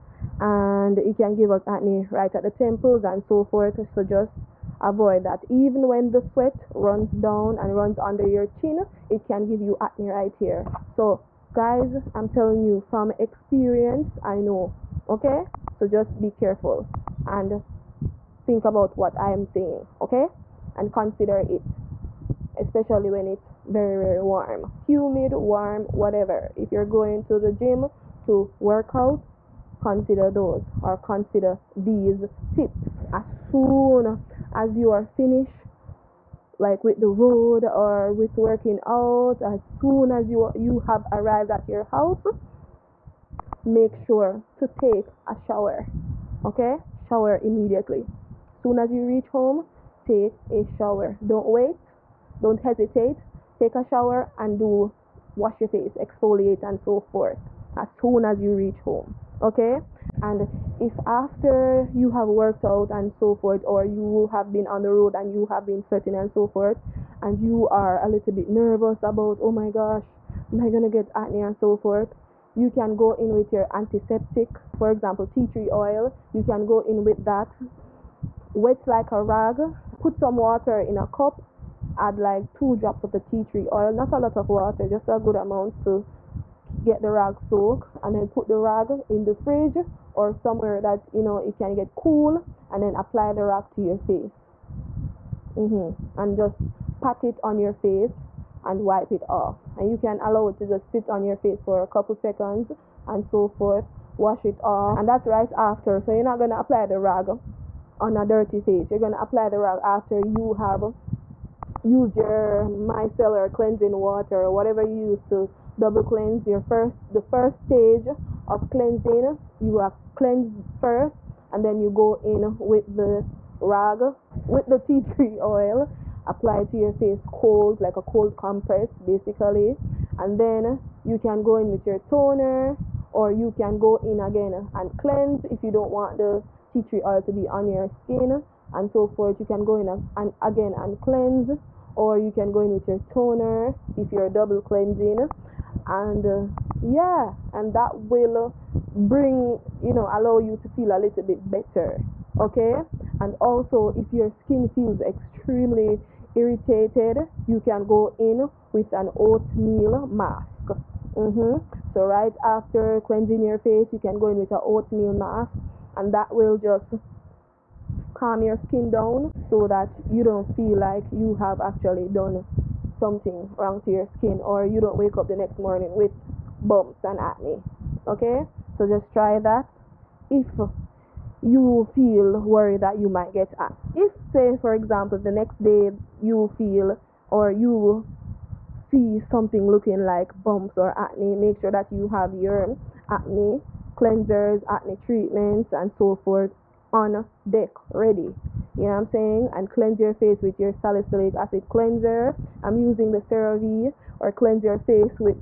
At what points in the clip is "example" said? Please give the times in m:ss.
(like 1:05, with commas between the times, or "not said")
1:14, 3:04.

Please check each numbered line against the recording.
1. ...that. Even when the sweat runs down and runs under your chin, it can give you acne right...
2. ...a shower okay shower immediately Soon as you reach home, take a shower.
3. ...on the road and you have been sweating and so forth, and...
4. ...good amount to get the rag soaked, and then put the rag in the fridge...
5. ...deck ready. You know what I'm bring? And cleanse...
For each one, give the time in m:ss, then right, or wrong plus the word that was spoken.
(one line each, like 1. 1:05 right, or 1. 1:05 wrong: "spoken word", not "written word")
1. 0:05 right
2. 0:45 right
3. 1:04 right
4. 1:25 right
5. 3:17 wrong: "saying", not "bring".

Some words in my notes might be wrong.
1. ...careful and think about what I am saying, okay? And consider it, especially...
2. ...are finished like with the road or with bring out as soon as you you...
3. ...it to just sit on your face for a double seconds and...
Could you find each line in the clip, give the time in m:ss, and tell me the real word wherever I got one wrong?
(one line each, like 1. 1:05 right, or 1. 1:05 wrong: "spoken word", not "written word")
1. 0:16 right
2. 0:34 wrong: "working", not "bring"
3. 1:40 wrong: "couple", not "double".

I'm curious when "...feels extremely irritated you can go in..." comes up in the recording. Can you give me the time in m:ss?
2:34.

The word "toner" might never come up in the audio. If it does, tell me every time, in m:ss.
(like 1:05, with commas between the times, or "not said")
2:11, 2:22.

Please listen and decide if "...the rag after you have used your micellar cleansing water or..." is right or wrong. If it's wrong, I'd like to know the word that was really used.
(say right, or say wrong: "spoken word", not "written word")
right.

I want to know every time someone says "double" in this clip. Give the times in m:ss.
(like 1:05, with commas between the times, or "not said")
1:55, 2:24.